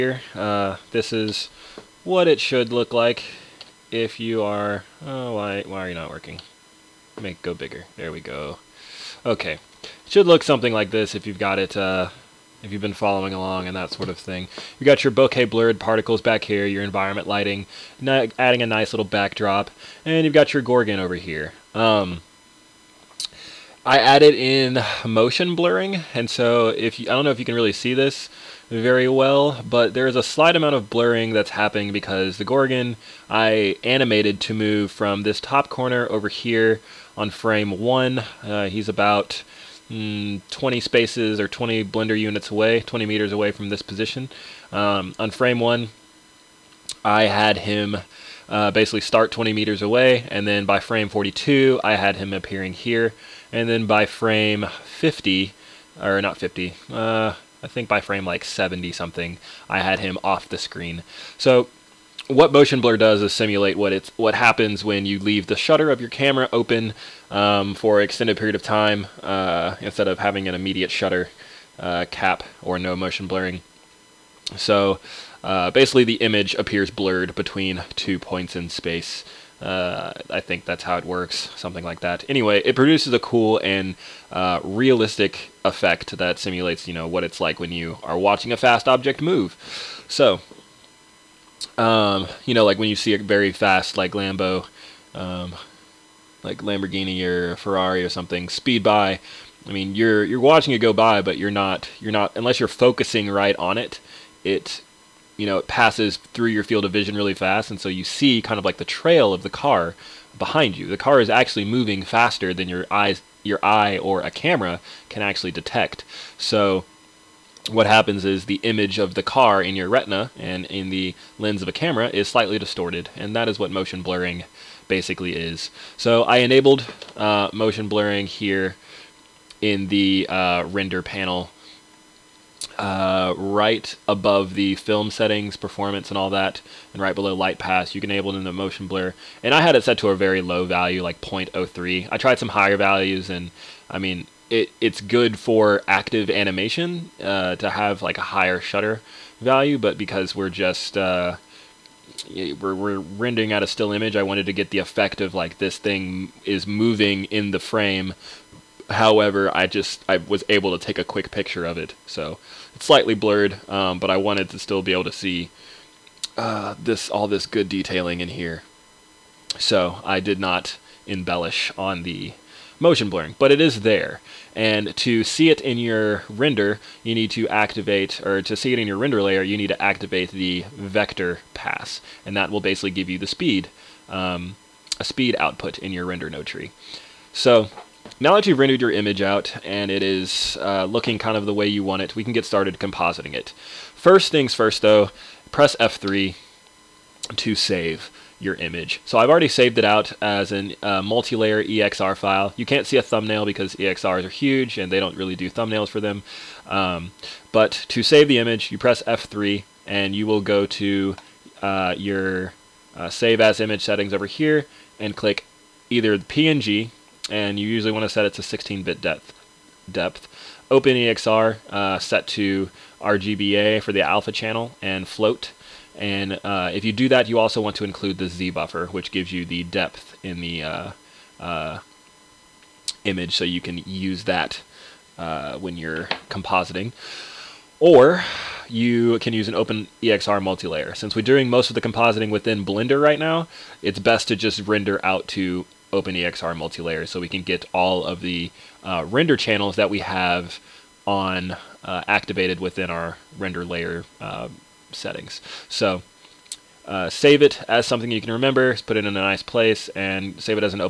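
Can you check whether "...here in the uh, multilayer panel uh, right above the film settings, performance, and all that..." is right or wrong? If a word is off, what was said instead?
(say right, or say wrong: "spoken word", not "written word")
wrong: "render", not "multilayer".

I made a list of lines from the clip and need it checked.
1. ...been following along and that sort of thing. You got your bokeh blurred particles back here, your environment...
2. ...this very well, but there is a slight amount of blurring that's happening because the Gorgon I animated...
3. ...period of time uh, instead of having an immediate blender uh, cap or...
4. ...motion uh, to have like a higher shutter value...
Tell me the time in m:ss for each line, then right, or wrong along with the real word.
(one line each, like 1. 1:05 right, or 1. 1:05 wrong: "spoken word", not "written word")
1. 0:12 right
2. 0:27 right
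3. 1:08 wrong: "shutter", not "blender"
4. 2:26 wrong: "animation", not "motion".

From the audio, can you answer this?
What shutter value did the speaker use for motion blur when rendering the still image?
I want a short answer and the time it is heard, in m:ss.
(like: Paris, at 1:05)
0.03, at 2:21.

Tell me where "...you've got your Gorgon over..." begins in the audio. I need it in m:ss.
0:20.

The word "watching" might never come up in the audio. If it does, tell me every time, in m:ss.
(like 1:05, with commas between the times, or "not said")
1:28, 1:40.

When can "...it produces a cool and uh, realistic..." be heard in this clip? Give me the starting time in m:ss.
1:22.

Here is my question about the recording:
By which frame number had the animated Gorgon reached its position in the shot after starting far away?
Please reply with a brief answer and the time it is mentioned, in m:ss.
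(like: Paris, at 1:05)
42, at 0:50.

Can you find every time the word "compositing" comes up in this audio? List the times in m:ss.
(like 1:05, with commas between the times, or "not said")
3:12, 3:56, 4:01.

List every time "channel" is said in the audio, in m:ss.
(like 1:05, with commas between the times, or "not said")
3:44, 4:09.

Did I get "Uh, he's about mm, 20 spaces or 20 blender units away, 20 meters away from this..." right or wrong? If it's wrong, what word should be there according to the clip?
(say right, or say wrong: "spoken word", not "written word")
right.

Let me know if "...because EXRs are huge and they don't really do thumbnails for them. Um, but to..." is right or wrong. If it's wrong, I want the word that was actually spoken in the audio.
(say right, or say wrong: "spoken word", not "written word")
right.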